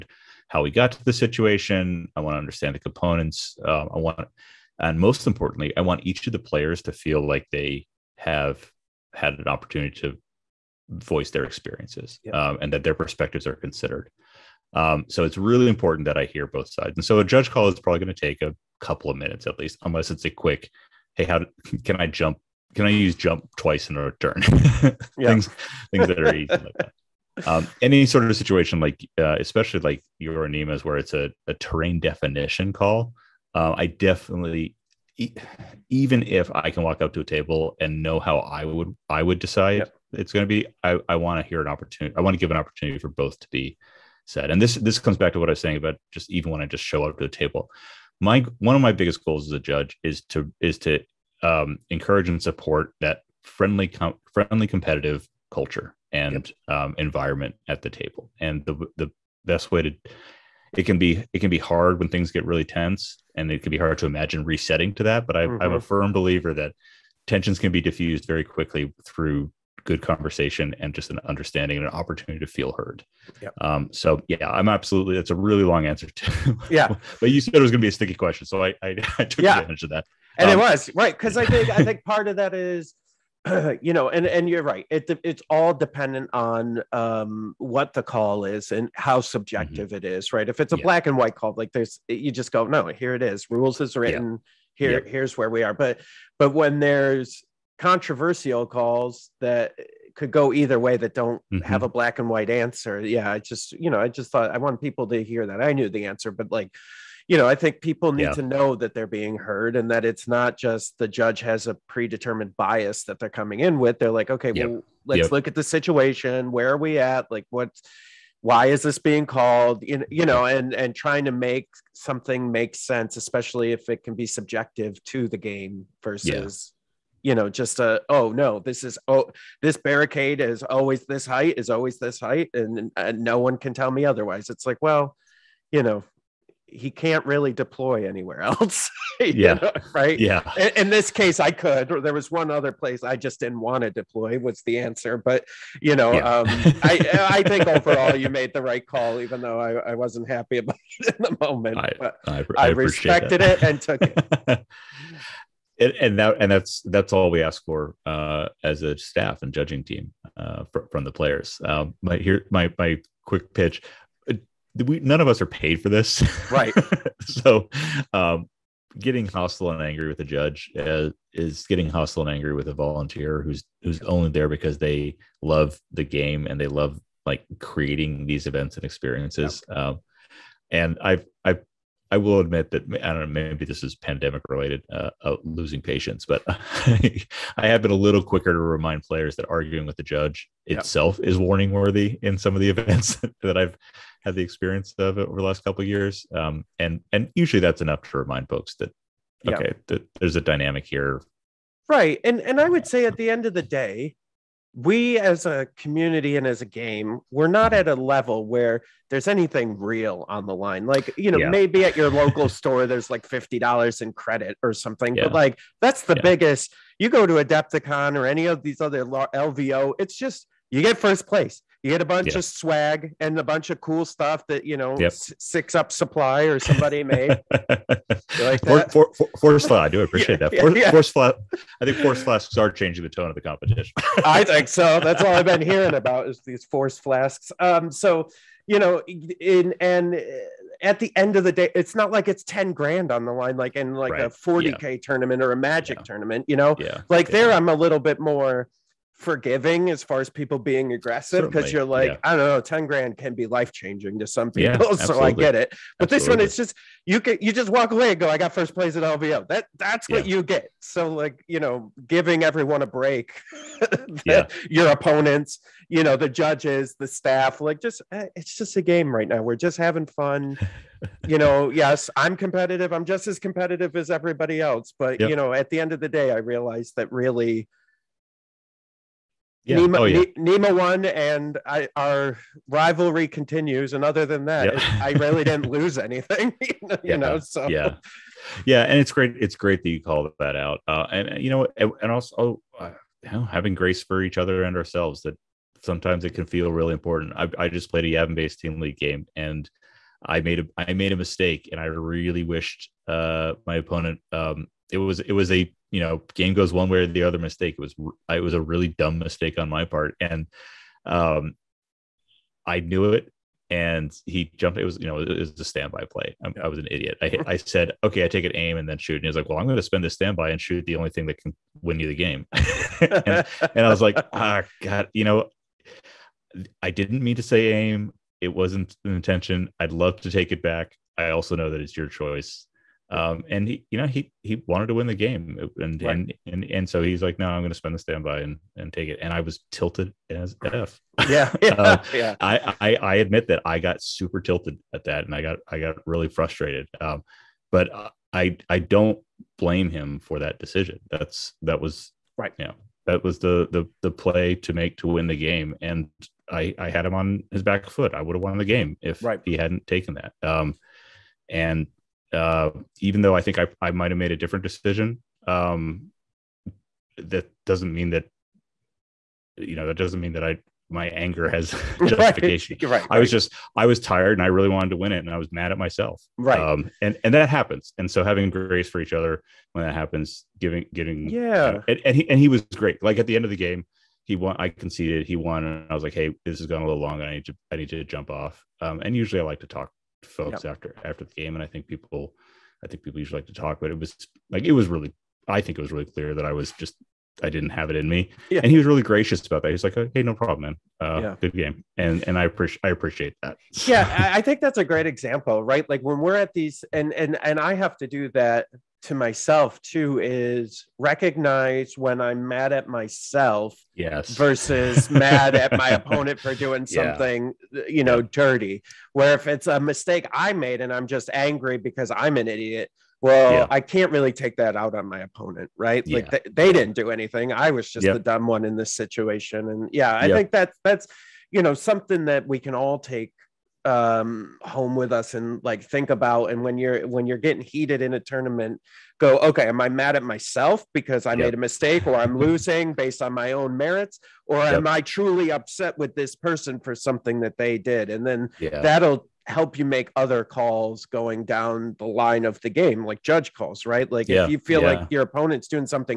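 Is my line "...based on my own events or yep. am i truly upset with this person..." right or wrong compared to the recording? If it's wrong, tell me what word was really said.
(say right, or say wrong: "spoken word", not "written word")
wrong: "merits", not "events".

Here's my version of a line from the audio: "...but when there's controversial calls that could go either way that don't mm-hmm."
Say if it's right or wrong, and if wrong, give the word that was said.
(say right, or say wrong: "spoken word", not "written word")
right.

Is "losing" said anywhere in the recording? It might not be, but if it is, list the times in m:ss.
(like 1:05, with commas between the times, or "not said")
3:05, 7:22.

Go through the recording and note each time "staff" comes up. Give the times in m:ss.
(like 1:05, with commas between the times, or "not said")
2:38, 4:27.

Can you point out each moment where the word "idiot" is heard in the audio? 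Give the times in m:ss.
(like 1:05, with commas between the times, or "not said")
5:16, 7:02.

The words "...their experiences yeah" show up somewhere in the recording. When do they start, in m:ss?
0:11.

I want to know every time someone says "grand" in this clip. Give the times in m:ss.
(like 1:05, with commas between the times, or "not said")
4:02, 4:12.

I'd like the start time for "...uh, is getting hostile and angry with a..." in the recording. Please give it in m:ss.
2:50.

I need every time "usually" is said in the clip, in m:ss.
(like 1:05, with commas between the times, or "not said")
3:17, 6:29, 6:33.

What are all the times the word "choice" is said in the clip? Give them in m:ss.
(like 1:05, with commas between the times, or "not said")
5:32.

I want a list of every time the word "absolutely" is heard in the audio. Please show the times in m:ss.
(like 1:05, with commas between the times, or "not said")
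1:14, 4:16.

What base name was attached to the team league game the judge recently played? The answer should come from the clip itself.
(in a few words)
Yavin.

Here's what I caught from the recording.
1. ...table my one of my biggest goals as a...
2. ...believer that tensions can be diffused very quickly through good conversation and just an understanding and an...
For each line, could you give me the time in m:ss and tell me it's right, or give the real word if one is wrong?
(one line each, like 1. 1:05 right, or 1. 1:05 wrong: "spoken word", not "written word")
1. 0:47 right
2. 1:06 right.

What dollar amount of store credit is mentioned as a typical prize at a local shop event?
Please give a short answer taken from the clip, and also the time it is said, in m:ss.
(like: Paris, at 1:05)
$50, at 3:33.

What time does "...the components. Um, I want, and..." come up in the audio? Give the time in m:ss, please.
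0:02.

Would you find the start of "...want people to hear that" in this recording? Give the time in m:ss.
1:44.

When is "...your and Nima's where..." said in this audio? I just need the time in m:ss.
0:30.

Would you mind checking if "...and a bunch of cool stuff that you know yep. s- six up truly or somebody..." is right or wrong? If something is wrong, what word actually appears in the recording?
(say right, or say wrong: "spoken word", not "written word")
wrong: "supply", not "truly".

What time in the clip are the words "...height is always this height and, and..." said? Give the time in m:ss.
2:11.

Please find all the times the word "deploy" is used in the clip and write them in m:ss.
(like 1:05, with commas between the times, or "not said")
2:17, 2:23.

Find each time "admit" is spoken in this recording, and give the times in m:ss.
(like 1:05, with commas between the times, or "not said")
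3:02, 5:43.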